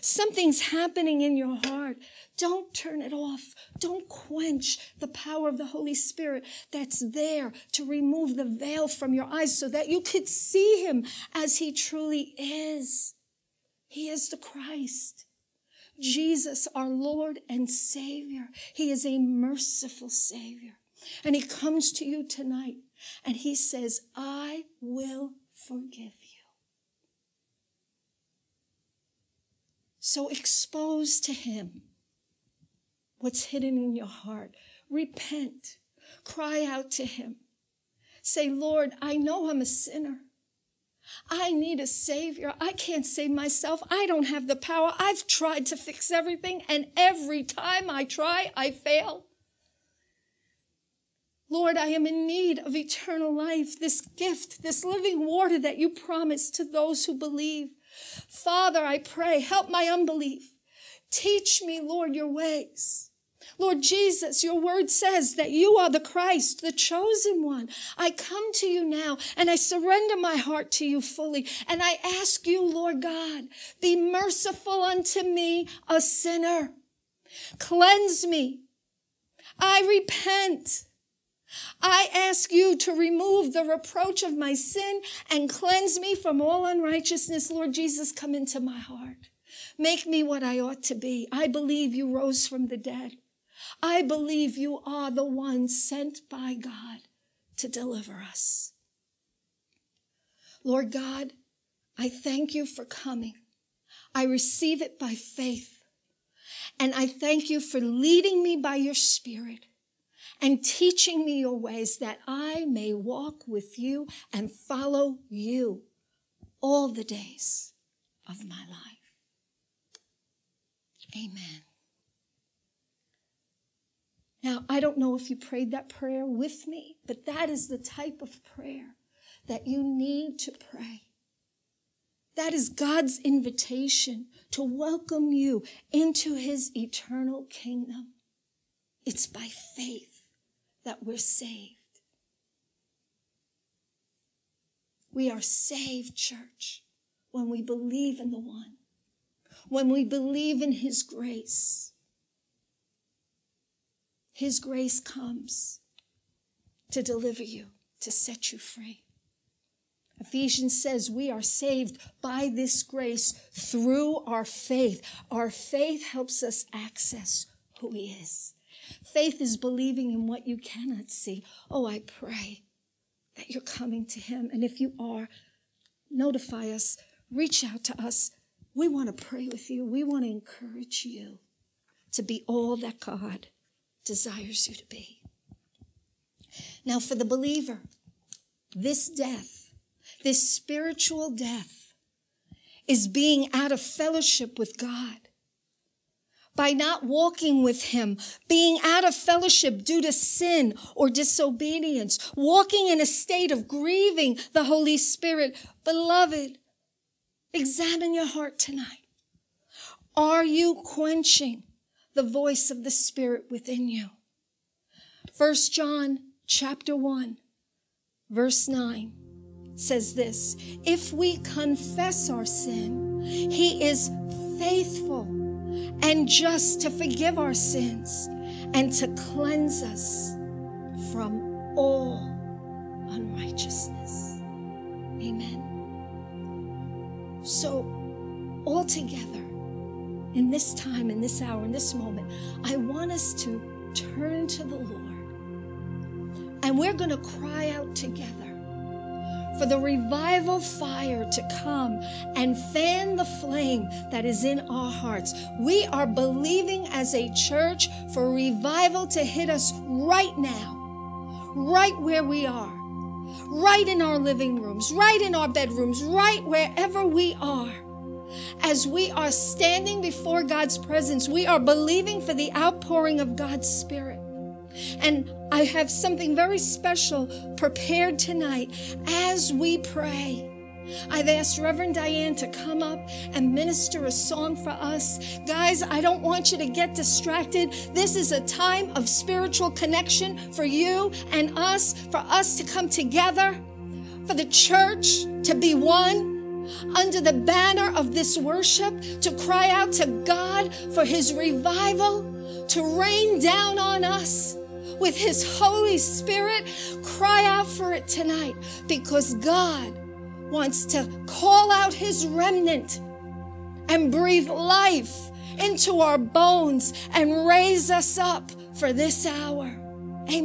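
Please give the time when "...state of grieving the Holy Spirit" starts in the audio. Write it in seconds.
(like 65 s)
203 s.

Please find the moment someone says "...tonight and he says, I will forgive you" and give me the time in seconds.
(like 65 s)
22 s.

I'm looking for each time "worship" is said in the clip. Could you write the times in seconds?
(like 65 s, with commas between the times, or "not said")
298 s.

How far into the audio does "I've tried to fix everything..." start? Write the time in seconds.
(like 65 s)
44 s.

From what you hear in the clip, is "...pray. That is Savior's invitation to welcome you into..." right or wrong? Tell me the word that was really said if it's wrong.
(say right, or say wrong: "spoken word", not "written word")
wrong: "God", not "Savior".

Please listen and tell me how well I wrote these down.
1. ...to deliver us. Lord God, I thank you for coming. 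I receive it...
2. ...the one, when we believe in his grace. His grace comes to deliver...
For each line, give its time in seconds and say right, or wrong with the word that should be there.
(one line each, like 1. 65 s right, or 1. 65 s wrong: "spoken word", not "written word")
1. 97 s right
2. 148 s right.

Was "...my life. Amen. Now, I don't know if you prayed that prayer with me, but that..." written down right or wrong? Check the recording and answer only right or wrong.
right.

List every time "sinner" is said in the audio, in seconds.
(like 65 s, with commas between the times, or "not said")
39 s, 76 s.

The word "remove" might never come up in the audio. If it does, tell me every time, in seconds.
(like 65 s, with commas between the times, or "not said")
7 s, 82 s.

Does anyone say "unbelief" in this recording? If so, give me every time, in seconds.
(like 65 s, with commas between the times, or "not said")
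59 s.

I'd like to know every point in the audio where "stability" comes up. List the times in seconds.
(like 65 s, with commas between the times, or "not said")
not said.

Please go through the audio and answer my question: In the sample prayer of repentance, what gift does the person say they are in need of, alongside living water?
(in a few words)
Eternal life.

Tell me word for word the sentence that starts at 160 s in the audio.
Ephesians says we are saved by this grace through our faith.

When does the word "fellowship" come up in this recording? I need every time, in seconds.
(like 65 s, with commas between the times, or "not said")
193 s, 199 s.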